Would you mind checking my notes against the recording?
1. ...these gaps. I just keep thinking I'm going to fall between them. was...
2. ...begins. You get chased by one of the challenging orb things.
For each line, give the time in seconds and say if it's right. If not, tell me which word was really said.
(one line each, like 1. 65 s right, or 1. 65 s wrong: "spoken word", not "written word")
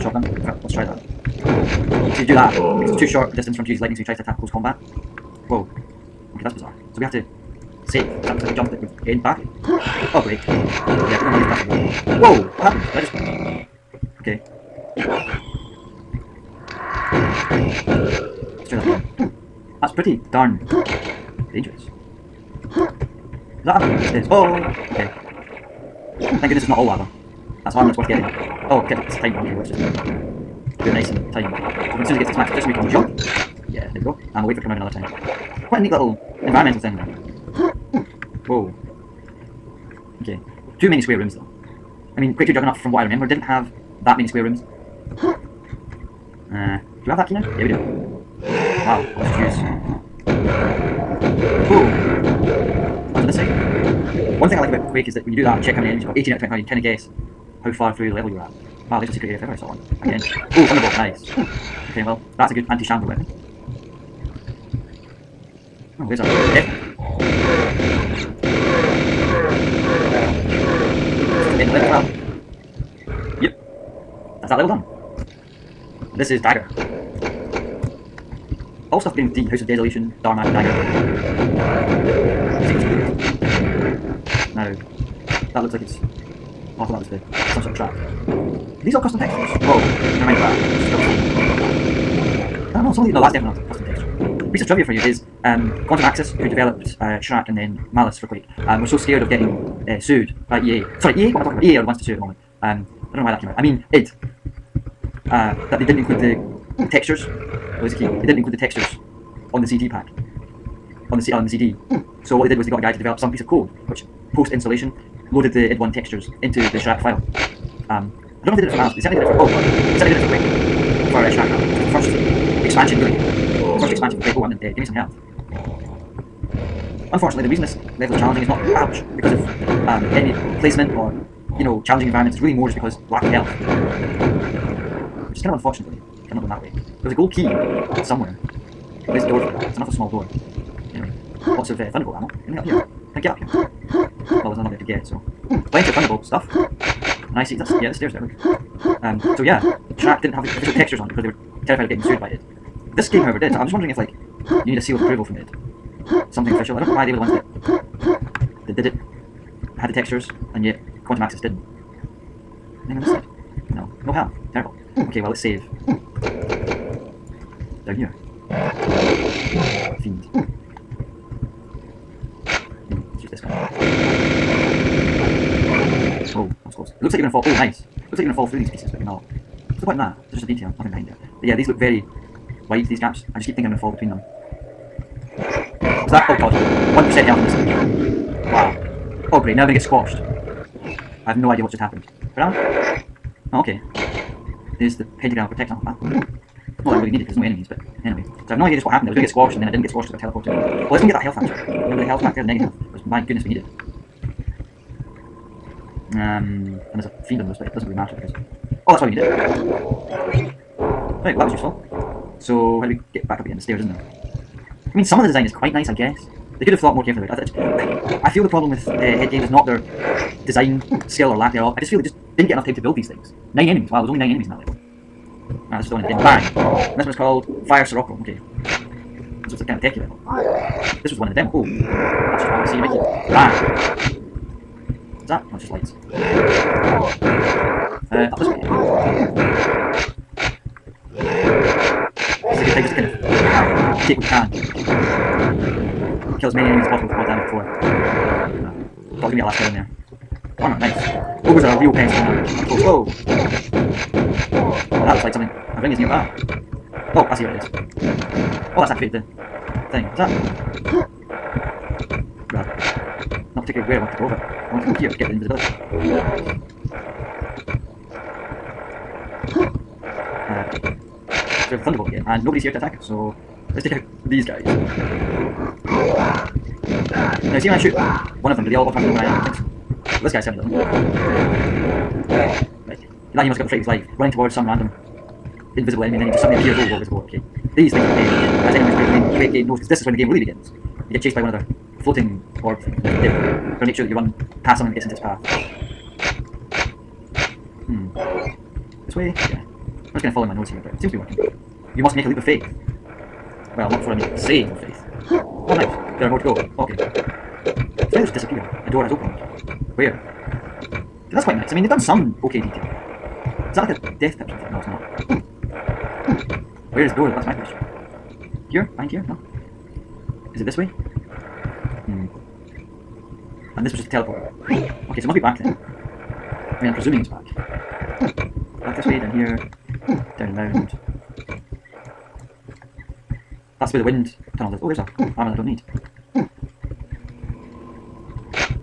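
1. 182 s right
2. 290 s wrong: "floating", not "challenging".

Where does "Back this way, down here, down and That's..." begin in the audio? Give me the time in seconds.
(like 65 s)
328 s.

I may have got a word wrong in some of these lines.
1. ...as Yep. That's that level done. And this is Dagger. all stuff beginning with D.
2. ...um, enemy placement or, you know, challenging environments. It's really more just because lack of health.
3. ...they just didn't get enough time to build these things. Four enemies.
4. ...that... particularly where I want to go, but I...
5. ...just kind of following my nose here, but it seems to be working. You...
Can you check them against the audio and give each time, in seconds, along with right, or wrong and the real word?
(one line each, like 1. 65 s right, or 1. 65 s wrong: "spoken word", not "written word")
1. 71 s right
2. 129 s right
3. 221 s wrong: "Nine", not "Four"
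4. 260 s right
5. 300 s right.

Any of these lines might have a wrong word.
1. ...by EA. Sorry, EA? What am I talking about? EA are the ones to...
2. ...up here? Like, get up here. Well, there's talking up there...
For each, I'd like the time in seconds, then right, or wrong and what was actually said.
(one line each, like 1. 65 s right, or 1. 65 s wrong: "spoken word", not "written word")
1. 100 s right
2. 142 s wrong: "nothing", not "talking".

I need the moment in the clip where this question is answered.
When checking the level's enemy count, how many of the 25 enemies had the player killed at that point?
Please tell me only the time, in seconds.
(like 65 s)
56 s.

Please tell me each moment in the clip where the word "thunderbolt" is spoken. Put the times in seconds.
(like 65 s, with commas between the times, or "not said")
60 s, 141 s, 145 s, 271 s.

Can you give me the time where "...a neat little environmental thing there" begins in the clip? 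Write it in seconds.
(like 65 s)
35 s.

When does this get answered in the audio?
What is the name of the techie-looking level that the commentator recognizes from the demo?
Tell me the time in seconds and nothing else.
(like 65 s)
227 s.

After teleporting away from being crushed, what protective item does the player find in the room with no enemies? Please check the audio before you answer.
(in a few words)
Pentagram of protection.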